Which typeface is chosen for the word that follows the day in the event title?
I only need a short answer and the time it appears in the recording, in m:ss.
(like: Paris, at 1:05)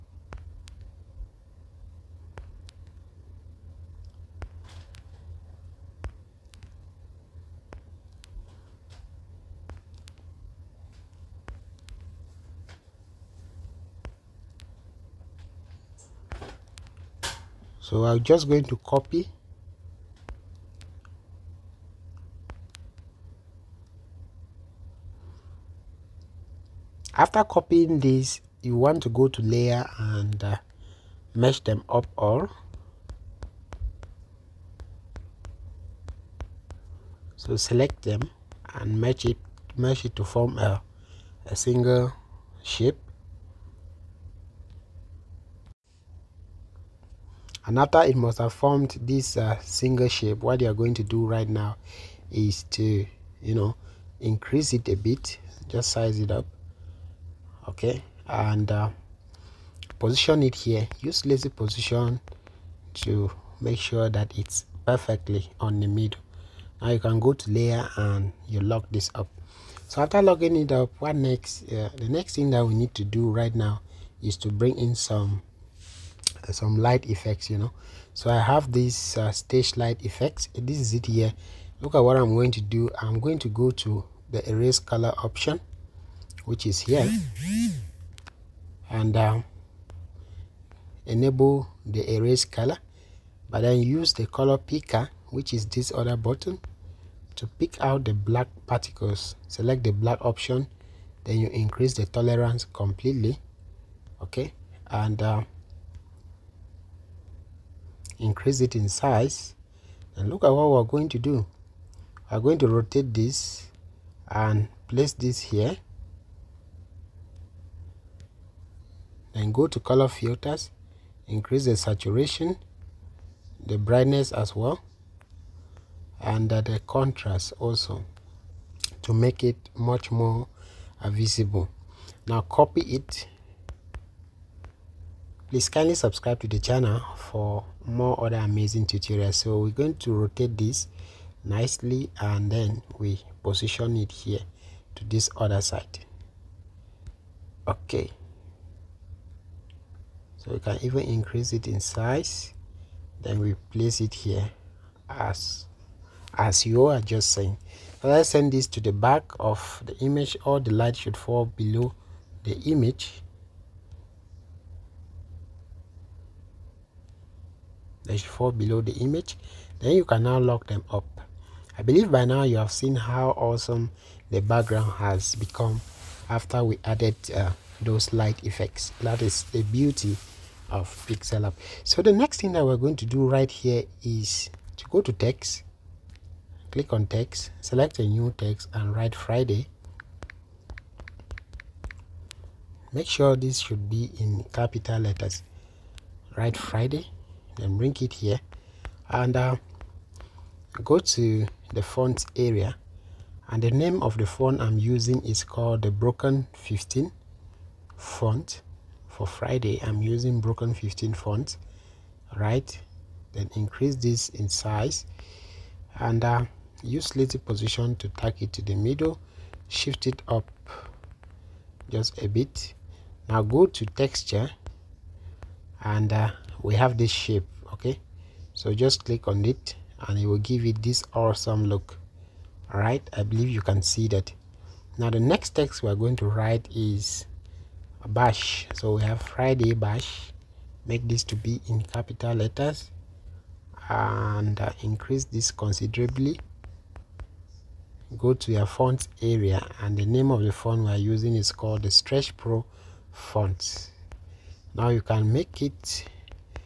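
Stretch Pro, at 4:11.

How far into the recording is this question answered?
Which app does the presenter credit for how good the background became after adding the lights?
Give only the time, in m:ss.
3:01.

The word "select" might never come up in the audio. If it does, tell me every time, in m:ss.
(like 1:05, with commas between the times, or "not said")
0:37, 1:39, 3:07.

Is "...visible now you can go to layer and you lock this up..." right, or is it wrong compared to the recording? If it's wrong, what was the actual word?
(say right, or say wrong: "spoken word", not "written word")
wrong: "middle", not "visible".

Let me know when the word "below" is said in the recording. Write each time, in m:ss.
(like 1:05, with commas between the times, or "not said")
2:41, 2:48.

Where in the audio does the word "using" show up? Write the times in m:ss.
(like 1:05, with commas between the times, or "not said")
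3:24, 3:30, 4:10.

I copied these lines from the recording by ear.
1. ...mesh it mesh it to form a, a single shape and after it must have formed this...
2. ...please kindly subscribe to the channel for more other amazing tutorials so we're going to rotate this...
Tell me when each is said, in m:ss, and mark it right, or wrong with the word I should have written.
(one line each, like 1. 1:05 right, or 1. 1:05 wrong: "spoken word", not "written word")
1. 0:39 right
2. 2:15 right.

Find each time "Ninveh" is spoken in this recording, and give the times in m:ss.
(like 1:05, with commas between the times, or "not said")
not said.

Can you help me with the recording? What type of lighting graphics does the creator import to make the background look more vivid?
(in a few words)
Stage light effects.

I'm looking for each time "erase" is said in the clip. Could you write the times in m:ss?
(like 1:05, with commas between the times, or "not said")
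1:24, 1:32.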